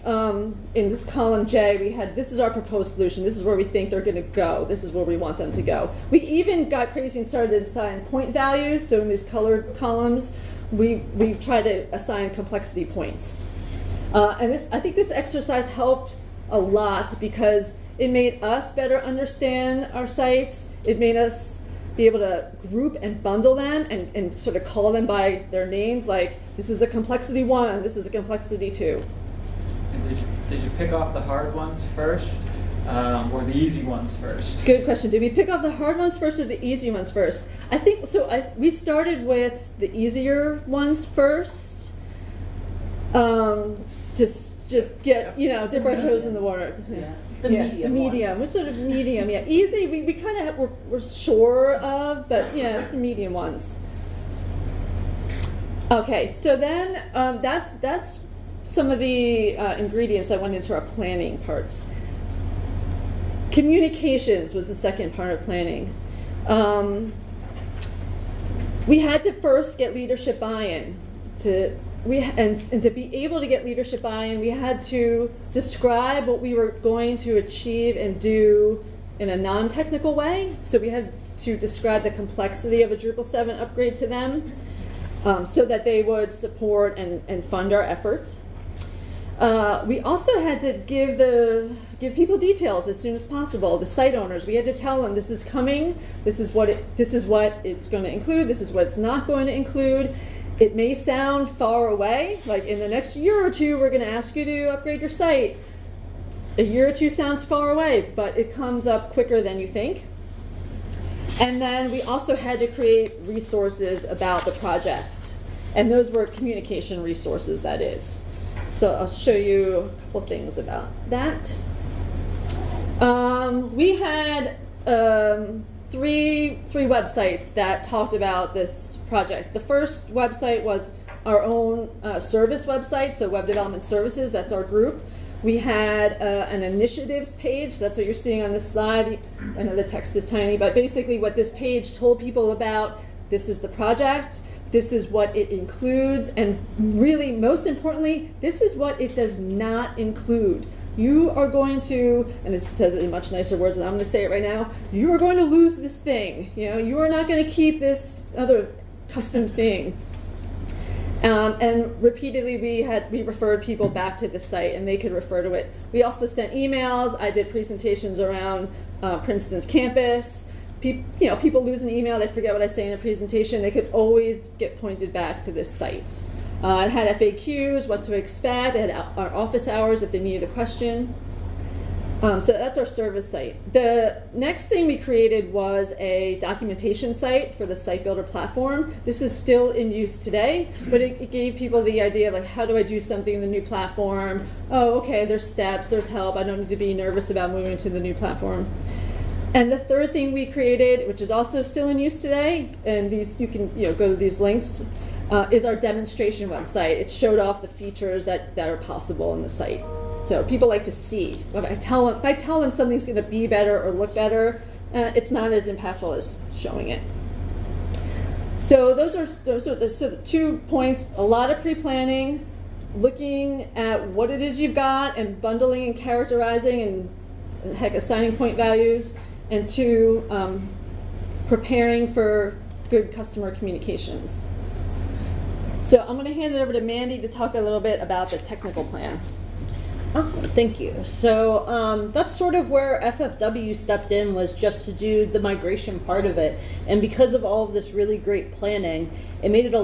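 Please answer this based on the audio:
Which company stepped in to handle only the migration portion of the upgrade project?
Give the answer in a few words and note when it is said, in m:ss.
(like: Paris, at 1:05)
FFW, at 4:03.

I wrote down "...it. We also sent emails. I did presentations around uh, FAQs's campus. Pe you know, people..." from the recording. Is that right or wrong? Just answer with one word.
wrong.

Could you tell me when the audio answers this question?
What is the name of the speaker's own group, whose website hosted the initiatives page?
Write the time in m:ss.
2:13.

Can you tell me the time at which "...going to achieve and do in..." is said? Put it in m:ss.
1:16.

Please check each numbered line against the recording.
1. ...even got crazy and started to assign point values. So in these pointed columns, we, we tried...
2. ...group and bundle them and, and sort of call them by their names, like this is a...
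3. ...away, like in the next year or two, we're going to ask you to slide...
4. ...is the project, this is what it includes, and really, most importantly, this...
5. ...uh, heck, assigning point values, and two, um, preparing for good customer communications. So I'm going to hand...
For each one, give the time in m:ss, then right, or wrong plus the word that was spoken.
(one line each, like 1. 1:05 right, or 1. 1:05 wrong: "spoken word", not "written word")
1. 0:06 wrong: "colored", not "pointed"
2. 0:22 right
3. 1:41 wrong: "upgrade", not "slide"
4. 2:23 right
5. 3:47 right.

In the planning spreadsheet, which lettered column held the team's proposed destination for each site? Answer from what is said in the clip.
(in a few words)
Column J.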